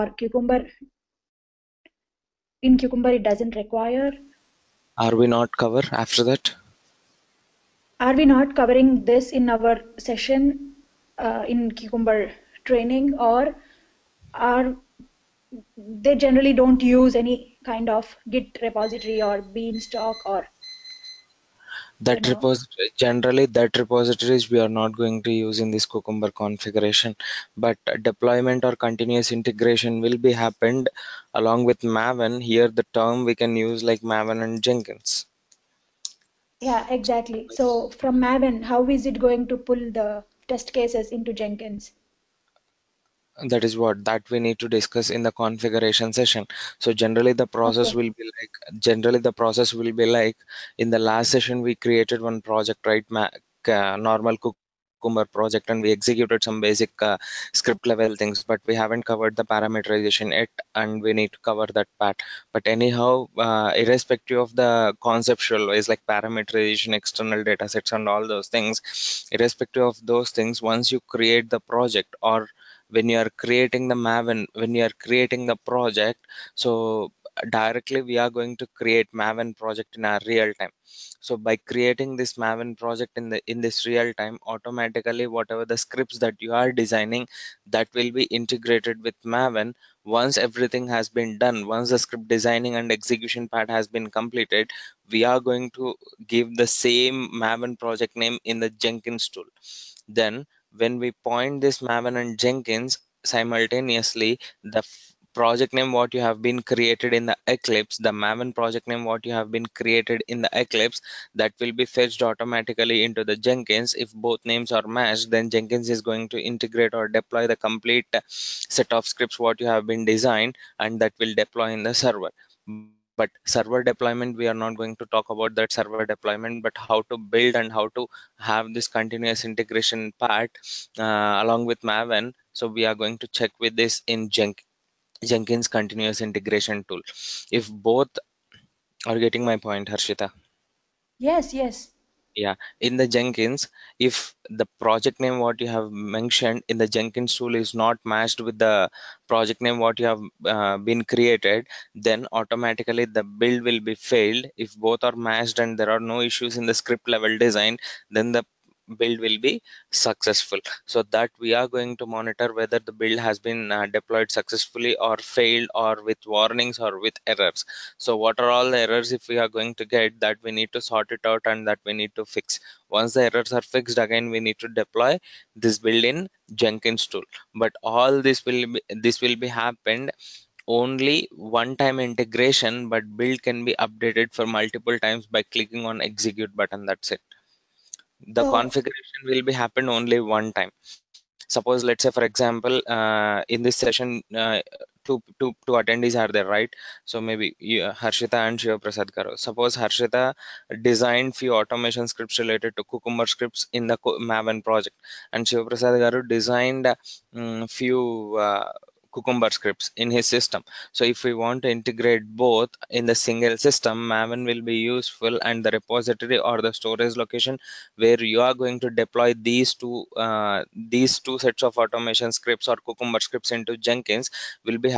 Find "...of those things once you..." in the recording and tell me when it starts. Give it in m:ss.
1:09.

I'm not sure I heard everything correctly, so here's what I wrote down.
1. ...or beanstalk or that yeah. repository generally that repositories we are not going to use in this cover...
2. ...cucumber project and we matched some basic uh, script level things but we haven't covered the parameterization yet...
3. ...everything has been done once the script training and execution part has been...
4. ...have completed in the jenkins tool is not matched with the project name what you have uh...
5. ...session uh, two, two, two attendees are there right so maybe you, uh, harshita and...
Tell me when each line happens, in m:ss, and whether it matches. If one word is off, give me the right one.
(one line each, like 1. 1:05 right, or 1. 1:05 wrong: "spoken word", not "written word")
1. 0:19 wrong: "cucumber", not "cover"
2. 0:55 wrong: "executed", not "matched"
3. 1:30 wrong: "designing", not "training"
4. 2:25 wrong: "mentioned", not "completed"
5. 3:13 right.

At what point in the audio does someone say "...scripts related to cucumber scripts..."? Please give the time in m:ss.
3:22.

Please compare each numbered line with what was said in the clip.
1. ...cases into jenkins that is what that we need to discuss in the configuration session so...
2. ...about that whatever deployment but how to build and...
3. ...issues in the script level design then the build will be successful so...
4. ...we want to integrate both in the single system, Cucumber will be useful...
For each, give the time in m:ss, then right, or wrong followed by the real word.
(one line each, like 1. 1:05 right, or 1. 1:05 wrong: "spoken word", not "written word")
1. 0:40 right
2. 2:05 wrong: "server", not "whatever"
3. 2:36 right
4. 3:31 wrong: "Maven", not "Cucumber".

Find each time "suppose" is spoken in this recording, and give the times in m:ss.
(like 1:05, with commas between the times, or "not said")
3:11, 3:19.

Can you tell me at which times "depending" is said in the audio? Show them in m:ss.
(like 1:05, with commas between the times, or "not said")
not said.